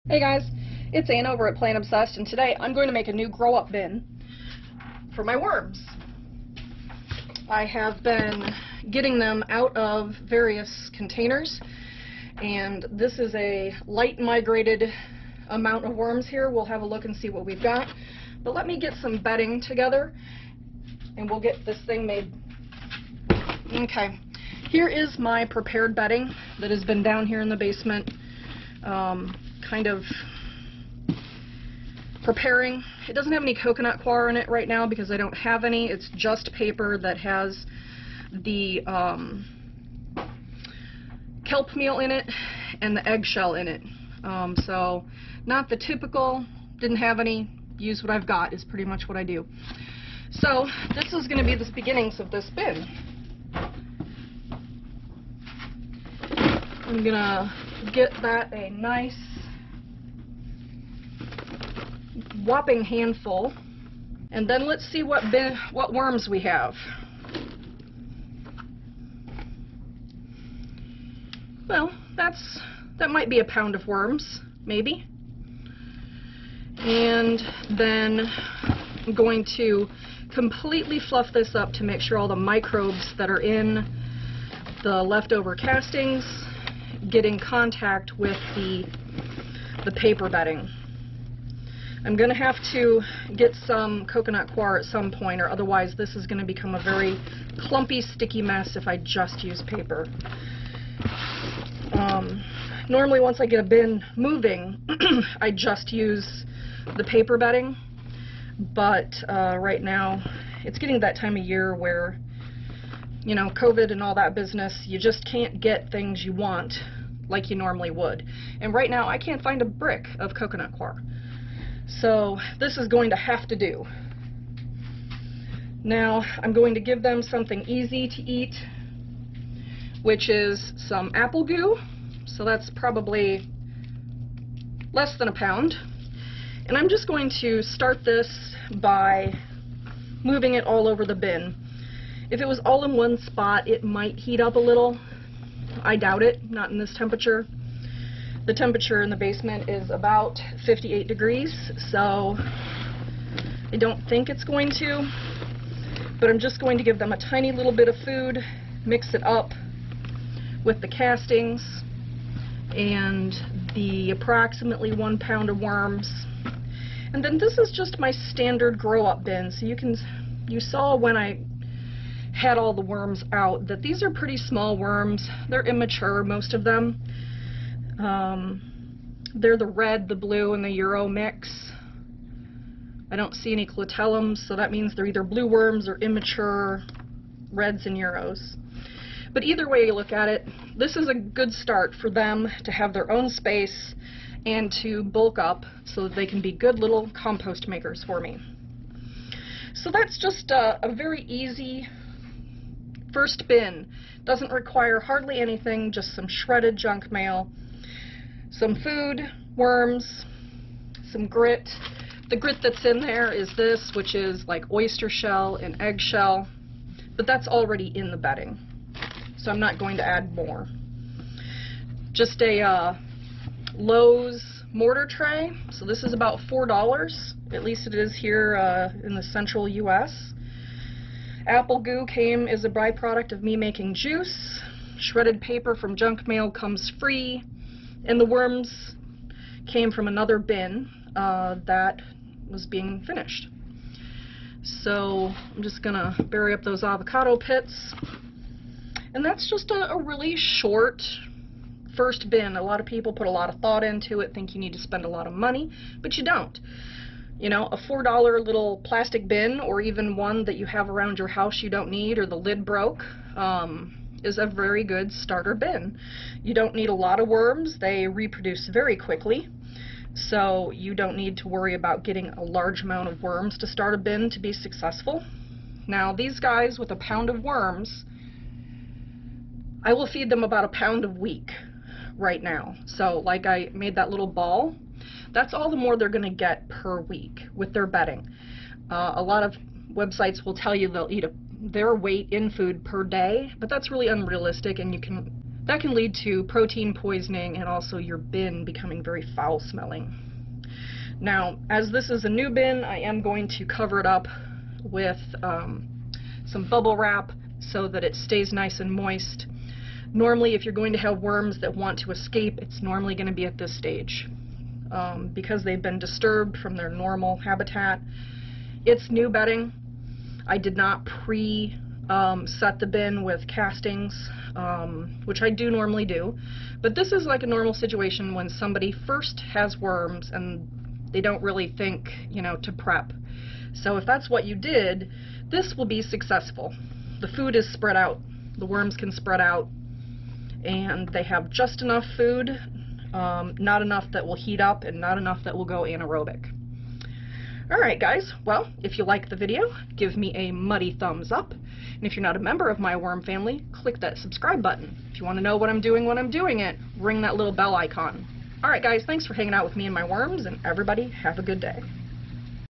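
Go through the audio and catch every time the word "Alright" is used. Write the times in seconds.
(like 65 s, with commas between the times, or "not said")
347 s, 358 s.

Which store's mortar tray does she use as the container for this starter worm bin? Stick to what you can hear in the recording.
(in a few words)
Lowe's.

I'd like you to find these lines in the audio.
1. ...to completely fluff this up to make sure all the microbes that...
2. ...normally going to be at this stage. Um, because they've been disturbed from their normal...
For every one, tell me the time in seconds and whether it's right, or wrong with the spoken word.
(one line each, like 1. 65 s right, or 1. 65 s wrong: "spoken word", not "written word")
1. 79 s right
2. 312 s right.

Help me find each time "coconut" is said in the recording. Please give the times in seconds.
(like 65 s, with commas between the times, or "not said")
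33 s, 94 s, 120 s.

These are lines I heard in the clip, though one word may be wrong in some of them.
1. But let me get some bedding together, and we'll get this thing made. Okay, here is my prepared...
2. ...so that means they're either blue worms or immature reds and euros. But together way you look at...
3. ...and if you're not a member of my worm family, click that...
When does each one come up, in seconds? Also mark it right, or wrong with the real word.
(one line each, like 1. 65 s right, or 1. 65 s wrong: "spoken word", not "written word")
1. 18 s right
2. 184 s wrong: "either", not "together"
3. 351 s right.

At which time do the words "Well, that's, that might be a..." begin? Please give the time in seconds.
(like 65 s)
71 s.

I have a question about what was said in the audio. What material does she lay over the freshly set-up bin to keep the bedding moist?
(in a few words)
bubble wrap.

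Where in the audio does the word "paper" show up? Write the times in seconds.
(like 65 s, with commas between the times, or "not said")
36 s, 89 s, 99 s, 107 s, 235 s.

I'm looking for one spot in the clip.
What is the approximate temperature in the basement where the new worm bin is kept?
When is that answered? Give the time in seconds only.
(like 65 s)
150 s.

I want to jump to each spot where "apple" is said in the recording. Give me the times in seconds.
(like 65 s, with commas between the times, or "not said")
131 s, 231 s.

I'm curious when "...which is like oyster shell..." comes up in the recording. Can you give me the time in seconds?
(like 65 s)
213 s.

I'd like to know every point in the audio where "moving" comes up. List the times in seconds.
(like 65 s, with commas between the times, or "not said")
104 s, 140 s.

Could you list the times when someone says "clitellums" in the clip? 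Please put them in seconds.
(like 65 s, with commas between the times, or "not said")
183 s.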